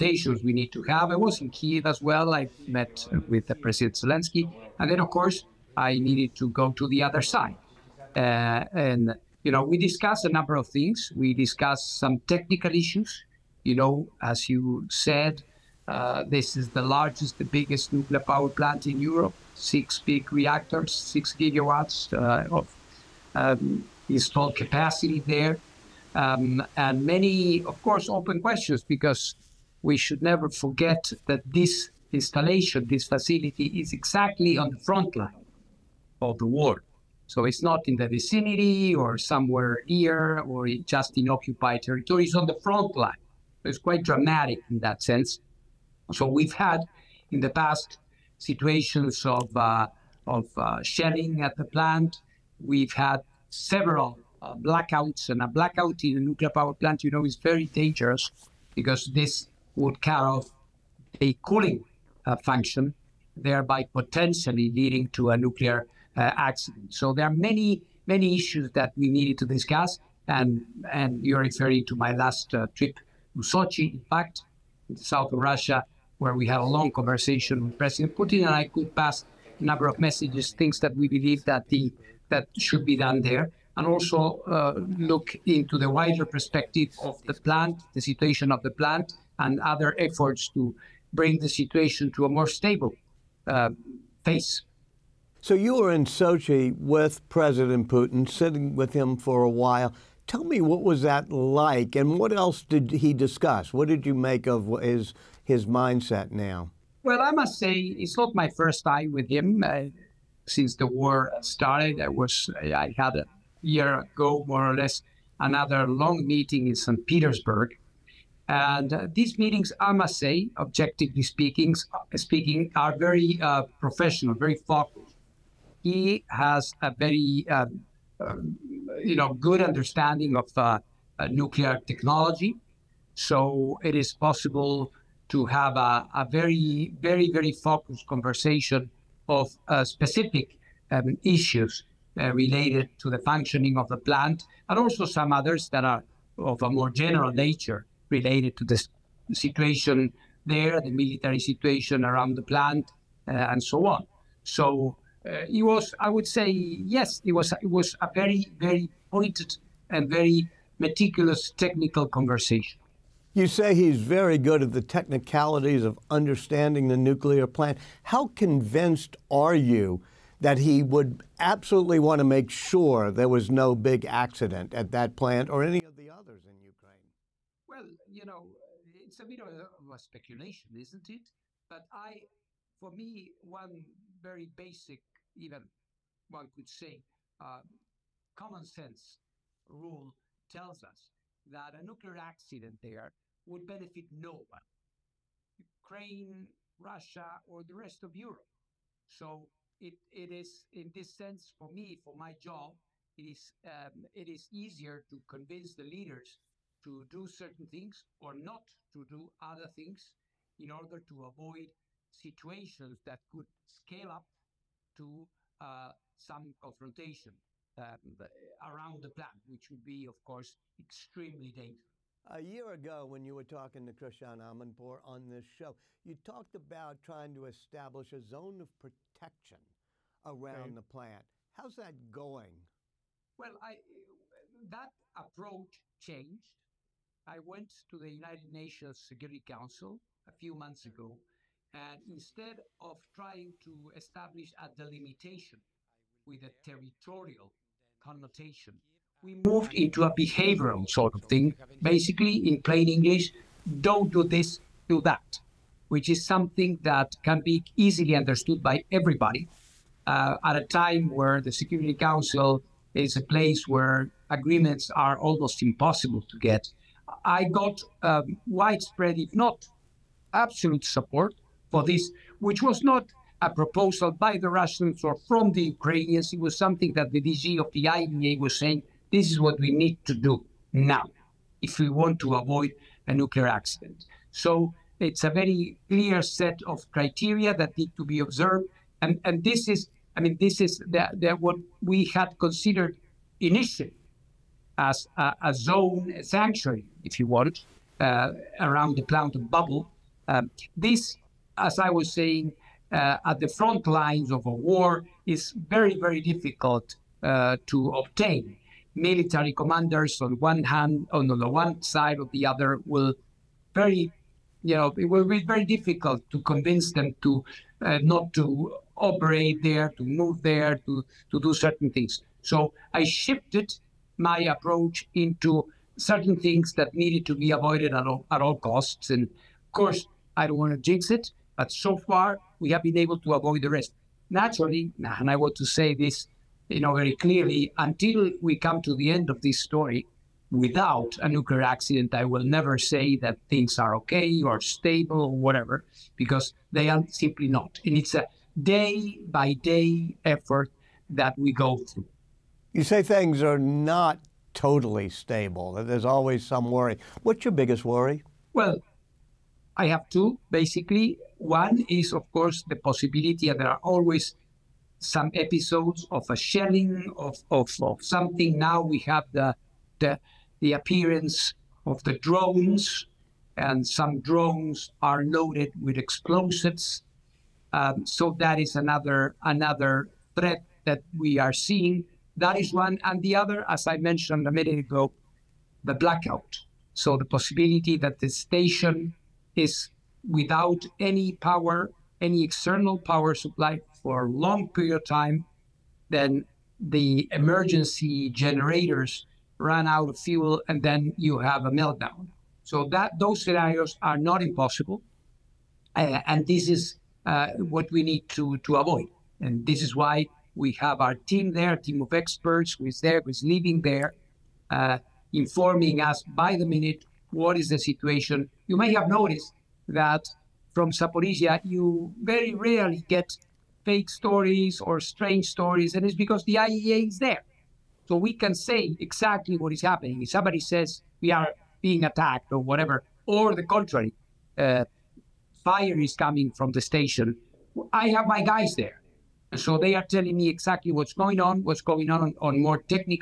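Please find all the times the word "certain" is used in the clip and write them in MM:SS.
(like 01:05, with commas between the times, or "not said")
03:27, 05:21, 05:25.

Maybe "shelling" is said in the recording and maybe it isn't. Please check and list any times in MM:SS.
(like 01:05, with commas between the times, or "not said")
00:50, 06:06.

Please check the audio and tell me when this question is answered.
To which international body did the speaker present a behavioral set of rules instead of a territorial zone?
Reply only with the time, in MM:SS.
03:58.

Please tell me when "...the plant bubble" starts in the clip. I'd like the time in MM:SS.
04:58.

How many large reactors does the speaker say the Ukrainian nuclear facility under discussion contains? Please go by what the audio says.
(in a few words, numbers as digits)
6.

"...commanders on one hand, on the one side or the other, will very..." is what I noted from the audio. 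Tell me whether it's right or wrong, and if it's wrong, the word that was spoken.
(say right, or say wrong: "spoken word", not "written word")
right.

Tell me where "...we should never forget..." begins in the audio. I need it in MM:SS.
00:29.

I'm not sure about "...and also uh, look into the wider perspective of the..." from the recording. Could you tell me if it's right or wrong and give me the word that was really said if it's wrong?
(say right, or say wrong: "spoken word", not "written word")
right.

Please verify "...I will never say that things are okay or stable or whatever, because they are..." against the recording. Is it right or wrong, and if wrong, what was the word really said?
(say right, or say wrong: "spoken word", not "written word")
right.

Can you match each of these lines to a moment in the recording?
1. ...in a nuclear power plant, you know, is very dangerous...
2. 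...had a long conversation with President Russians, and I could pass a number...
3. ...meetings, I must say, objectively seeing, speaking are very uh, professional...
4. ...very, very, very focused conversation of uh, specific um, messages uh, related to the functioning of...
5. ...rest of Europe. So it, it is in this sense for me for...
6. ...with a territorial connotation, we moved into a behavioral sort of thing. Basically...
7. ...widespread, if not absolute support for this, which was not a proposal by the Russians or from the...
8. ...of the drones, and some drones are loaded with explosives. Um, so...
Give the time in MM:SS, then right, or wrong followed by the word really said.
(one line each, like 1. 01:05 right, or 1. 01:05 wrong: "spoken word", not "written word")
1. 00:56 right
2. 01:16 wrong: "Putin", not "Russians"
3. 01:59 wrong: "speaking", not "seeing"
4. 02:16 wrong: "issues", not "messages"
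5. 03:17 right
6. 04:06 right
7. 04:28 right
8. 06:11 right.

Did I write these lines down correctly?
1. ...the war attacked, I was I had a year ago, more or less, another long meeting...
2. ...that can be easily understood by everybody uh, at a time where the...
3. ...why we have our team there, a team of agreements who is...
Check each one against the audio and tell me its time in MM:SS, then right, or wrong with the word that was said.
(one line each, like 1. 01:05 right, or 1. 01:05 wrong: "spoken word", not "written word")
1. 01:50 wrong: "started", not "attacked"
2. 04:16 right
3. 06:49 wrong: "experts", not "agreements".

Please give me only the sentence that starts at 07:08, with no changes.
So we can say exactly what is happening.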